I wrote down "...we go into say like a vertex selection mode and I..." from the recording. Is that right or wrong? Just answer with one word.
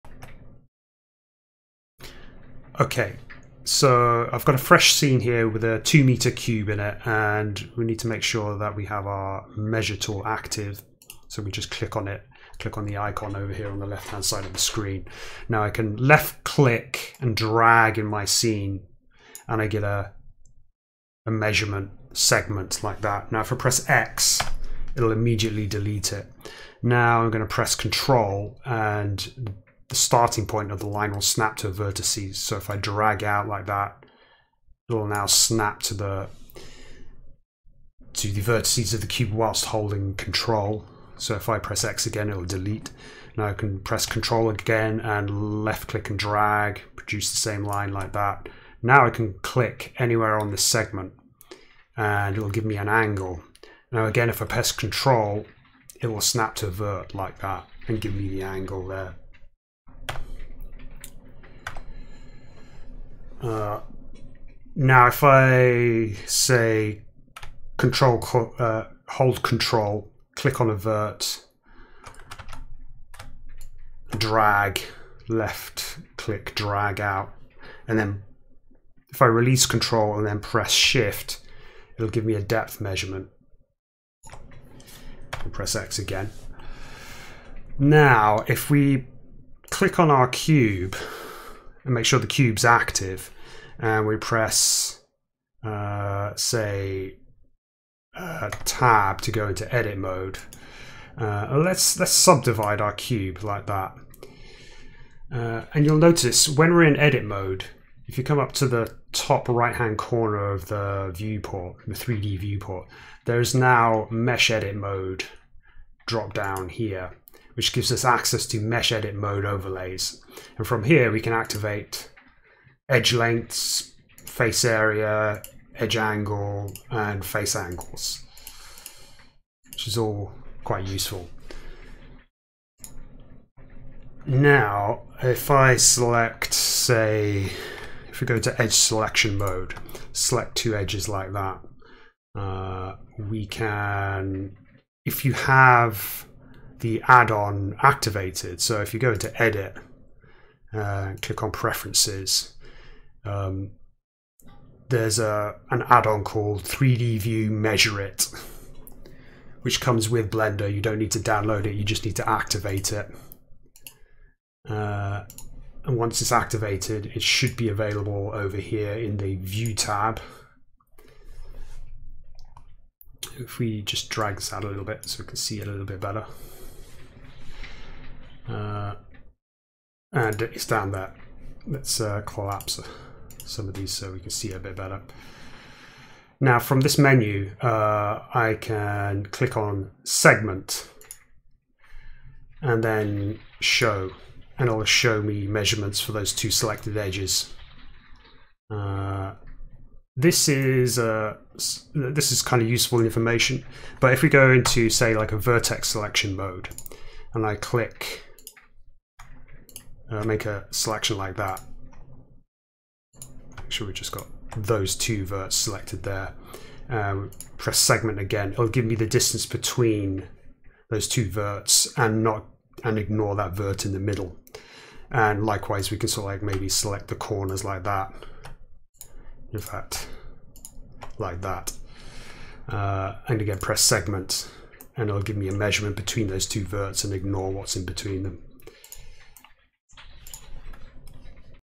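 right.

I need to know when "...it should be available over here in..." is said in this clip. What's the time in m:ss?
2:47.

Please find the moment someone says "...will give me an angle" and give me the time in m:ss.
0:52.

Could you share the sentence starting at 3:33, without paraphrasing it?
Make sure we just got those two verts selected there.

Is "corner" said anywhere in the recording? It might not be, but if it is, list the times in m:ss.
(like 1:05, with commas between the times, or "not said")
1:49, 3:47.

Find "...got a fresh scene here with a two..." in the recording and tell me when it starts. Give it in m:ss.
0:04.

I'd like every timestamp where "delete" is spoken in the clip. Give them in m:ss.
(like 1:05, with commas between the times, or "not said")
0:25, 0:42.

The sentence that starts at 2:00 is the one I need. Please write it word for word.
And from here, we can activate edge lengths, face area, edge angle, and face angles, which is all quite useful.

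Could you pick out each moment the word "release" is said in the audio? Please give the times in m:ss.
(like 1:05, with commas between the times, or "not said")
1:19.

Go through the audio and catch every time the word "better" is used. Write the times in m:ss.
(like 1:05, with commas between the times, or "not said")
2:55, 3:04.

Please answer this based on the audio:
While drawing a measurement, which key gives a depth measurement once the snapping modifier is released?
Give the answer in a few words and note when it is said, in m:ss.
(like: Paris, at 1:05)
shift, at 1:20.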